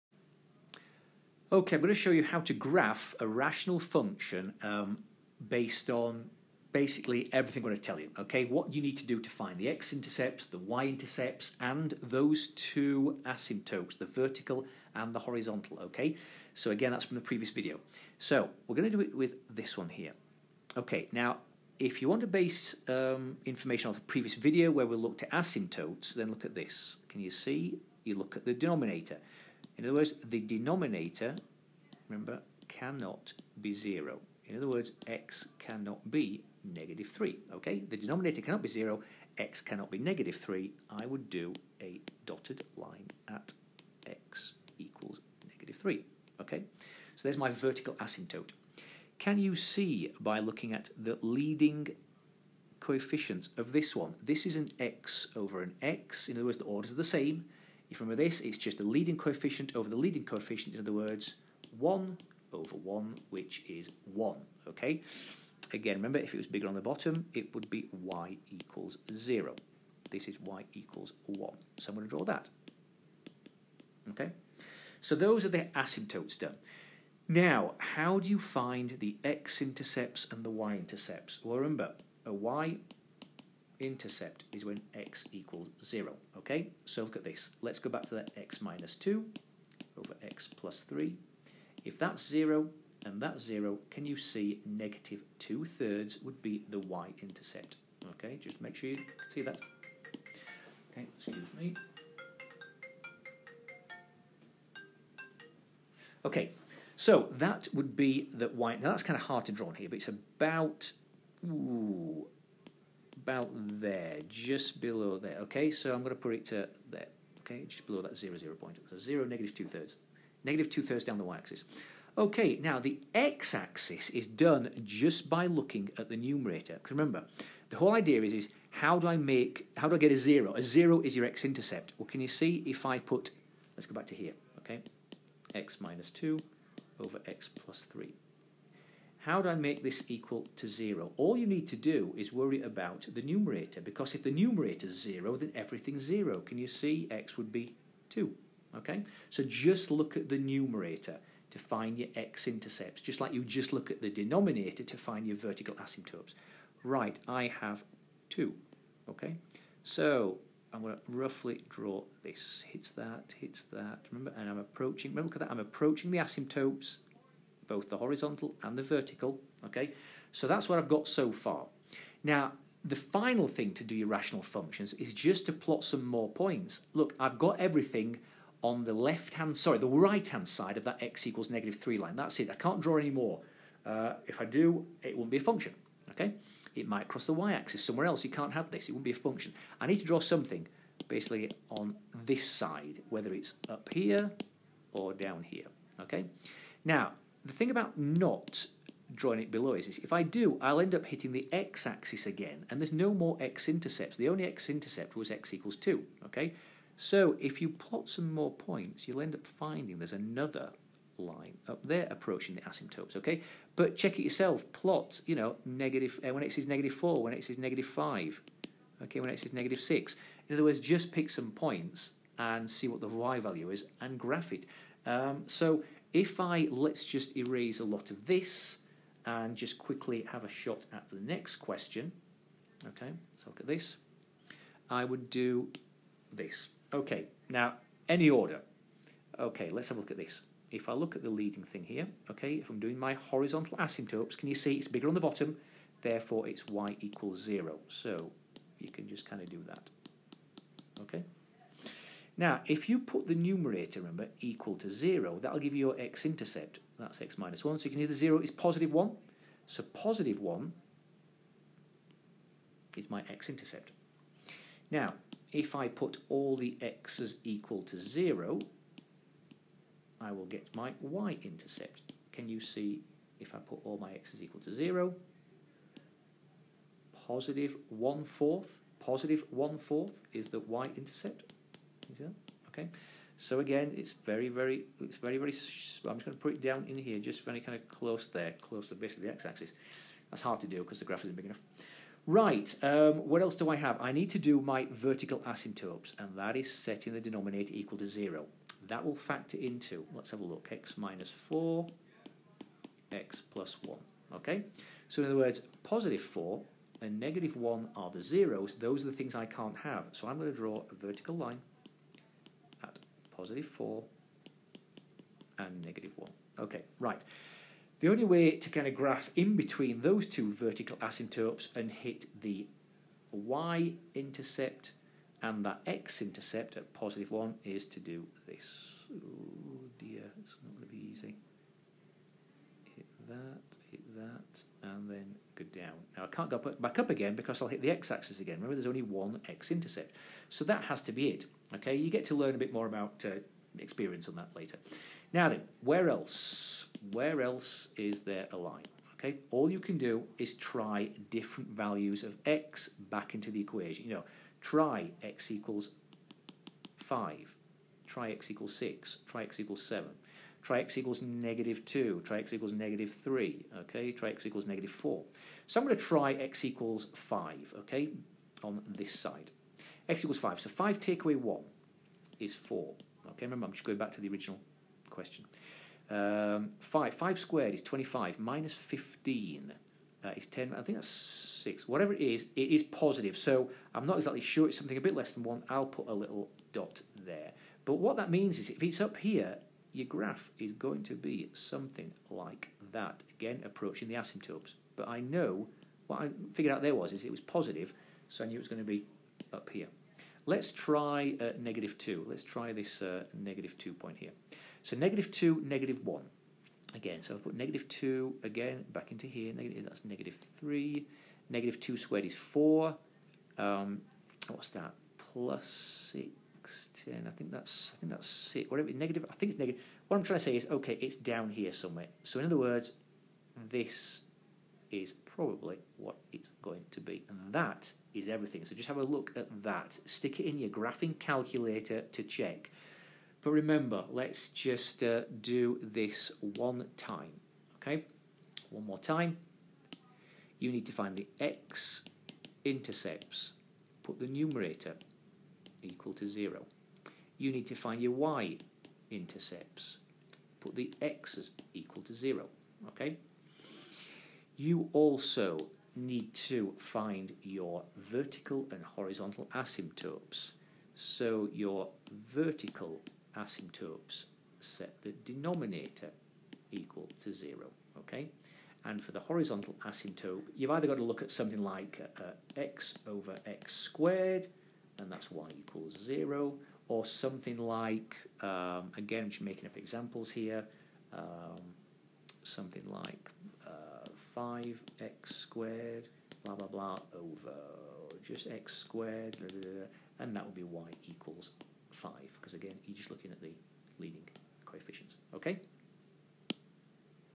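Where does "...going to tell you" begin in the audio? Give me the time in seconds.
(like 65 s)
7 s.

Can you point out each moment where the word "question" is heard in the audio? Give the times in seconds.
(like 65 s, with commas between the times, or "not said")
231 s, 375 s.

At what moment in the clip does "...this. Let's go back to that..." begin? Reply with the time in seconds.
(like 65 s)
87 s.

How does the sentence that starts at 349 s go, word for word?
Okay, all you can do is try different values of x back into the equation.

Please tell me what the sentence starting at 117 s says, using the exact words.
Okay, just below that zero zero point.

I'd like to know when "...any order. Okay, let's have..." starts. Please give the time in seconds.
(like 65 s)
238 s.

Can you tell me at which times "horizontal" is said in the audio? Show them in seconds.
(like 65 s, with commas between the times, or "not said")
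15 s, 167 s, 243 s, 458 s, 469 s.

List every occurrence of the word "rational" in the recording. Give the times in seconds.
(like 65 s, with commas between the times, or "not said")
3 s, 174 s.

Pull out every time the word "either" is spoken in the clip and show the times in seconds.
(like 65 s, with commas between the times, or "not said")
258 s, 470 s.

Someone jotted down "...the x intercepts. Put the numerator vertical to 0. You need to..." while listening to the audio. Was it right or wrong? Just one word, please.
wrong.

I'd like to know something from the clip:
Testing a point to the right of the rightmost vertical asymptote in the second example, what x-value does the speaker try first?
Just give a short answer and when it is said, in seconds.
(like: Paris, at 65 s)
5, at 365 s.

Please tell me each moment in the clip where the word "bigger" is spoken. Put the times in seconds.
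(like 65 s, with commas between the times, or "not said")
66 s, 244 s.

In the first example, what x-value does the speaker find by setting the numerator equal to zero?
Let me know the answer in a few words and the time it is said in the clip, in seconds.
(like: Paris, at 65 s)
2, at 147 s.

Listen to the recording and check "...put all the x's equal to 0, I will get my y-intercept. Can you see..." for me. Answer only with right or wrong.
right.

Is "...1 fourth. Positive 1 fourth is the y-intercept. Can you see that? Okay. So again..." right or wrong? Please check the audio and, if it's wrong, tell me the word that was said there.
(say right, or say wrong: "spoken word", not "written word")
right.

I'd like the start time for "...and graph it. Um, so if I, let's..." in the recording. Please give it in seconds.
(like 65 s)
223 s.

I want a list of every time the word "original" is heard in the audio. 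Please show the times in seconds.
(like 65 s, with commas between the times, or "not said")
374 s.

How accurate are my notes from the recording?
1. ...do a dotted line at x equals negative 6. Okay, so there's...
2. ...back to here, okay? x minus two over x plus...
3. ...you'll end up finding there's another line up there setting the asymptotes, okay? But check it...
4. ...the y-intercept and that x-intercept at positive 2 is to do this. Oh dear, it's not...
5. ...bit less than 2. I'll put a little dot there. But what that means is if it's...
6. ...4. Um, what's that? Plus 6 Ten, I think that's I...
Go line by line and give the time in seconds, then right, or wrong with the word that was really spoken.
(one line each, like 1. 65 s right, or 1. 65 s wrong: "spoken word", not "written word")
1. 41 s wrong: "3", not "6"
2. 133 s right
3. 209 s wrong: "approaching", not "setting"
4. 322 s wrong: "1", not "2"
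5. 385 s wrong: "1", not "2"
6. 412 s right.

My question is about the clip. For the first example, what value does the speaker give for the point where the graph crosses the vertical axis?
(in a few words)
-2/3.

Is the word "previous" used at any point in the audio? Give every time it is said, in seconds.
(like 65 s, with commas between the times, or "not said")
17 s, 24 s.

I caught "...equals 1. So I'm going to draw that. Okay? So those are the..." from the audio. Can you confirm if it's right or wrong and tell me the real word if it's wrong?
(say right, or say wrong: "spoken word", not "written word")
right.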